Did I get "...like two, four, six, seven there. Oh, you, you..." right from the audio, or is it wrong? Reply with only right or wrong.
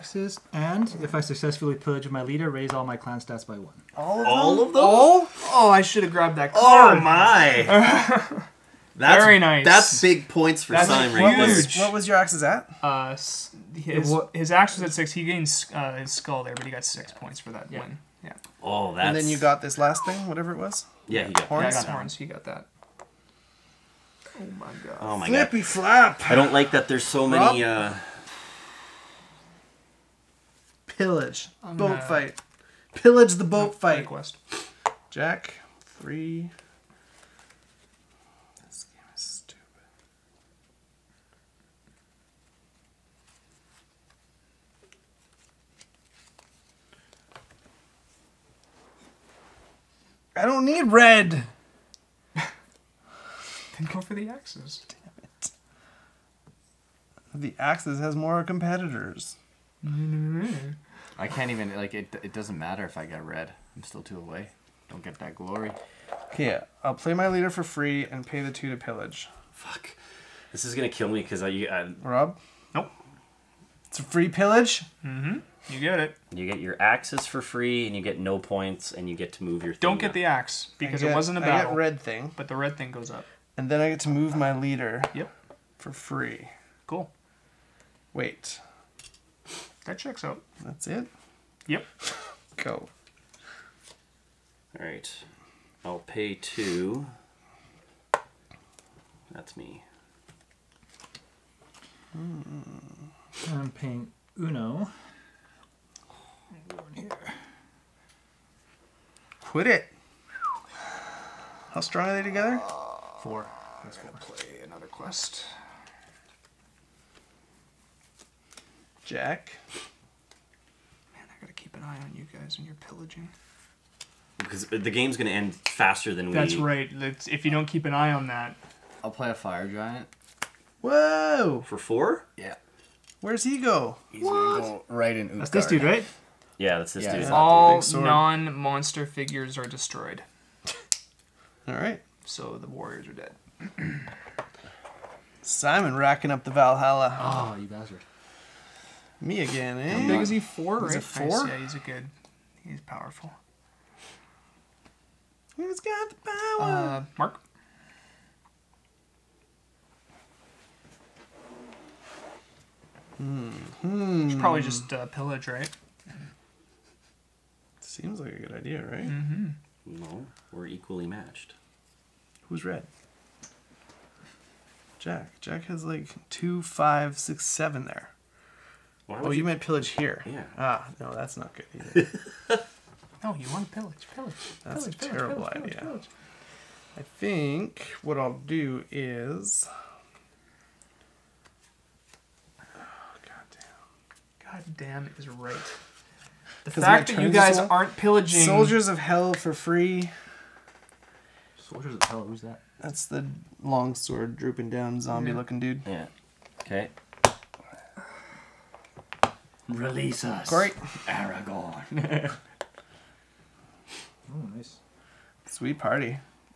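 wrong.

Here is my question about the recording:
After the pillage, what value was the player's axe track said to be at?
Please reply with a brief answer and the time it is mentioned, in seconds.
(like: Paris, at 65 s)
6, at 14 s.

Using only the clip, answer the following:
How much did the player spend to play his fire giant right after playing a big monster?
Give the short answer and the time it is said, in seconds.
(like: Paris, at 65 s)
4, at 131 s.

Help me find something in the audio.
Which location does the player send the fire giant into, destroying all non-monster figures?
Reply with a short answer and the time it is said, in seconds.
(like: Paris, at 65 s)
Utgard, at 135 s.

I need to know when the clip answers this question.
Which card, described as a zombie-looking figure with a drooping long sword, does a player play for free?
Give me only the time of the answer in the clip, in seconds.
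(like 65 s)
198 s.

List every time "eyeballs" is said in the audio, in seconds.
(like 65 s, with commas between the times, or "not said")
not said.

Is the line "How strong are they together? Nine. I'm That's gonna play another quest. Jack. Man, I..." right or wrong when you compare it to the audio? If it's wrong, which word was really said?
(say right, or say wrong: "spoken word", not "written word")
wrong: "Four", not "Nine".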